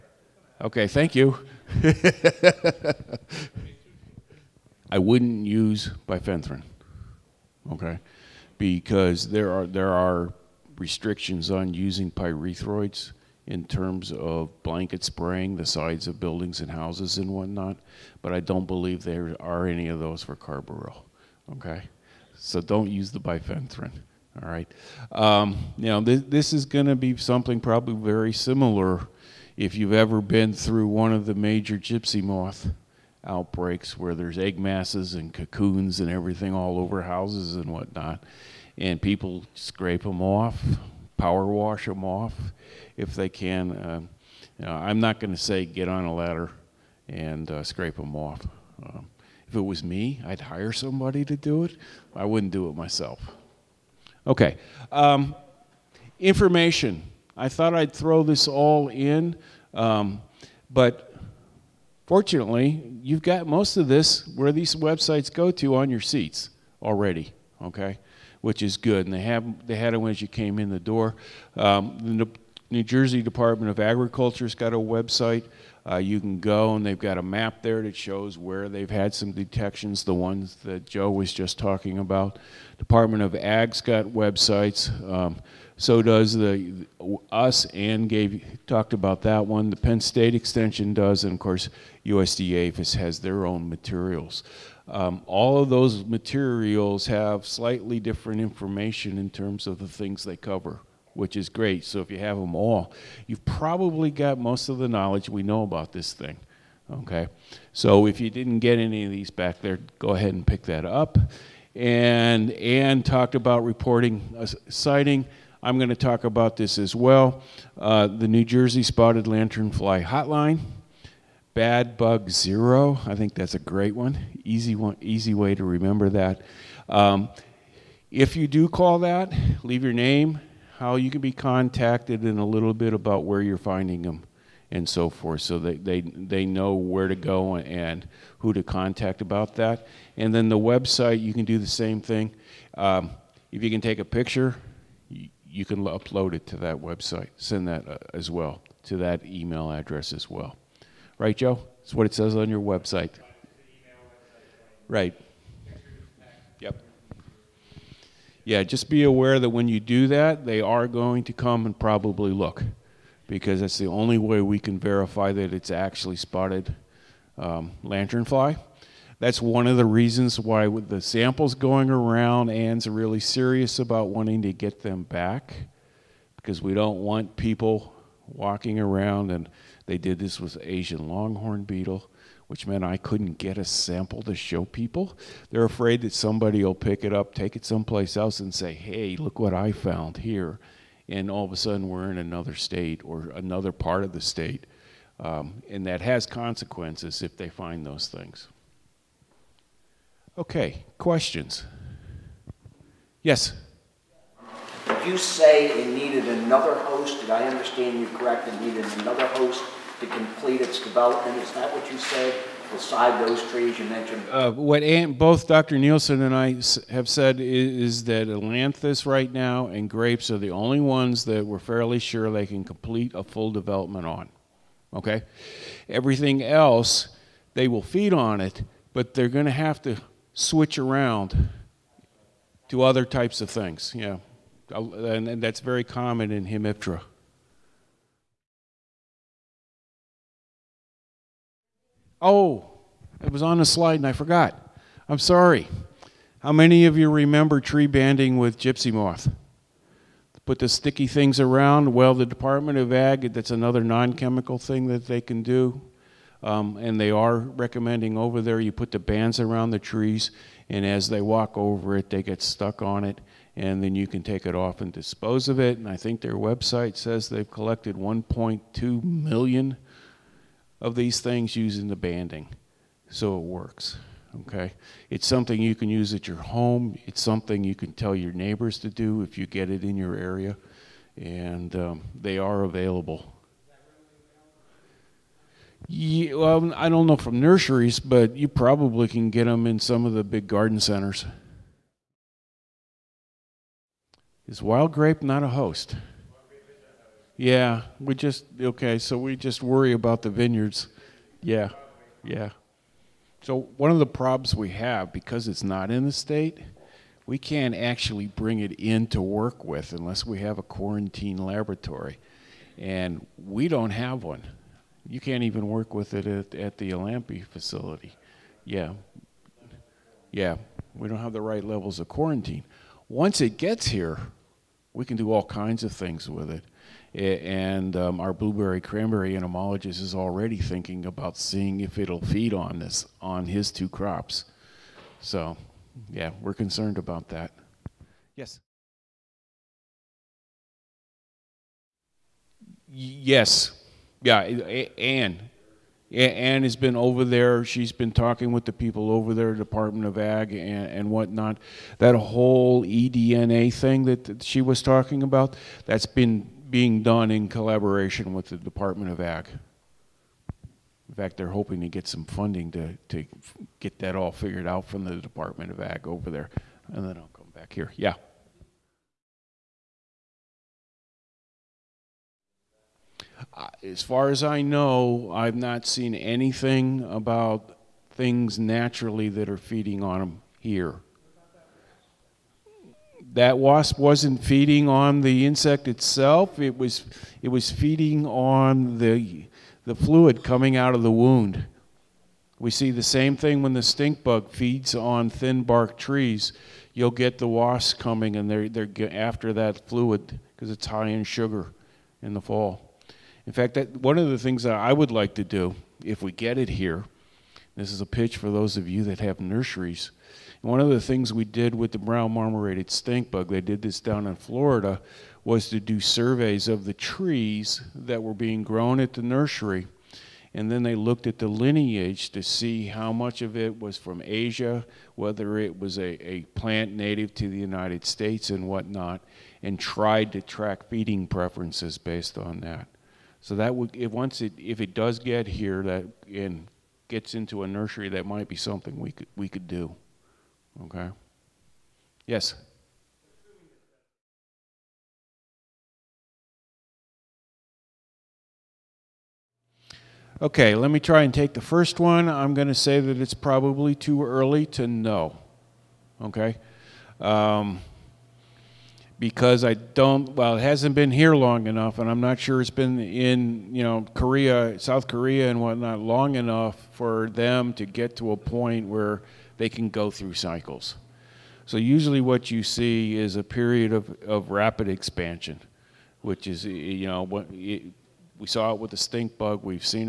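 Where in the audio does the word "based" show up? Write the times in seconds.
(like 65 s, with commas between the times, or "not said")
431 s.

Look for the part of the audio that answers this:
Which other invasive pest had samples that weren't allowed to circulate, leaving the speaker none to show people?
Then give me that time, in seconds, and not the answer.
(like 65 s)
180 s.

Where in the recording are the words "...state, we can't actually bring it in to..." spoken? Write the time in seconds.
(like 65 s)
306 s.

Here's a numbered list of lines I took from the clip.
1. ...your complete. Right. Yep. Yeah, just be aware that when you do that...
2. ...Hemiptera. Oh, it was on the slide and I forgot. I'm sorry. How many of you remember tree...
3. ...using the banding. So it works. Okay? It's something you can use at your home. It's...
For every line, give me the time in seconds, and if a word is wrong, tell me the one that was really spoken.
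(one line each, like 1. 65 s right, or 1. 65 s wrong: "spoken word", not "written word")
1. 152 s wrong: "website", not "complete"
2. 236 s right
3. 271 s right.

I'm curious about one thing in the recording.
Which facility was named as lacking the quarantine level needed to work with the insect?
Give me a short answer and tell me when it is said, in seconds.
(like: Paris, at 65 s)
Alampi facility, at 316 s.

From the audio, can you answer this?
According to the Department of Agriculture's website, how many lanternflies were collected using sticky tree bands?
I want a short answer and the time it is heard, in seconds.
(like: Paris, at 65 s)
1.2 million, at 267 s.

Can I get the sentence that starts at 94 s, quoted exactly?
Um, all of those materials have slightly different information in terms of the things they cover, which is great.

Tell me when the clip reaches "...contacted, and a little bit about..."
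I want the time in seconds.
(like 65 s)
131 s.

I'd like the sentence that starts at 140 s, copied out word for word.
And then the website, you can do the same thing.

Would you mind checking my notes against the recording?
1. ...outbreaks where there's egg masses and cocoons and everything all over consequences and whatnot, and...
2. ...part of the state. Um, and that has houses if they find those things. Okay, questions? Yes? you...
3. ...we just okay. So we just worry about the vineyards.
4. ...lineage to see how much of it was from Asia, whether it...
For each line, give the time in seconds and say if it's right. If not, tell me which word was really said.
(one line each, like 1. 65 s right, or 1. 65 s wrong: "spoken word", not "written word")
1. 33 s wrong: "houses", not "consequences"
2. 193 s wrong: "consequences", not "houses"
3. 297 s right
4. 421 s right.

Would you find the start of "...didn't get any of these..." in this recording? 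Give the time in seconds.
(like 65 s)
108 s.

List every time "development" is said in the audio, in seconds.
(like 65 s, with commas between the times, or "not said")
210 s, 223 s.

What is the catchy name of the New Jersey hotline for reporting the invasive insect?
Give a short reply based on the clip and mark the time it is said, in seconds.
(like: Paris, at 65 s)
Bad Bug Zero, at 121 s.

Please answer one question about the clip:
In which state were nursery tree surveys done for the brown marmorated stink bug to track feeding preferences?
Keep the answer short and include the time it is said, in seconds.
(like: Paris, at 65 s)
Florida, at 414 s.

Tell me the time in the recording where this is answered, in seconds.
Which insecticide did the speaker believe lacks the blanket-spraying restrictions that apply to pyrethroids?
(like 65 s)
20 s.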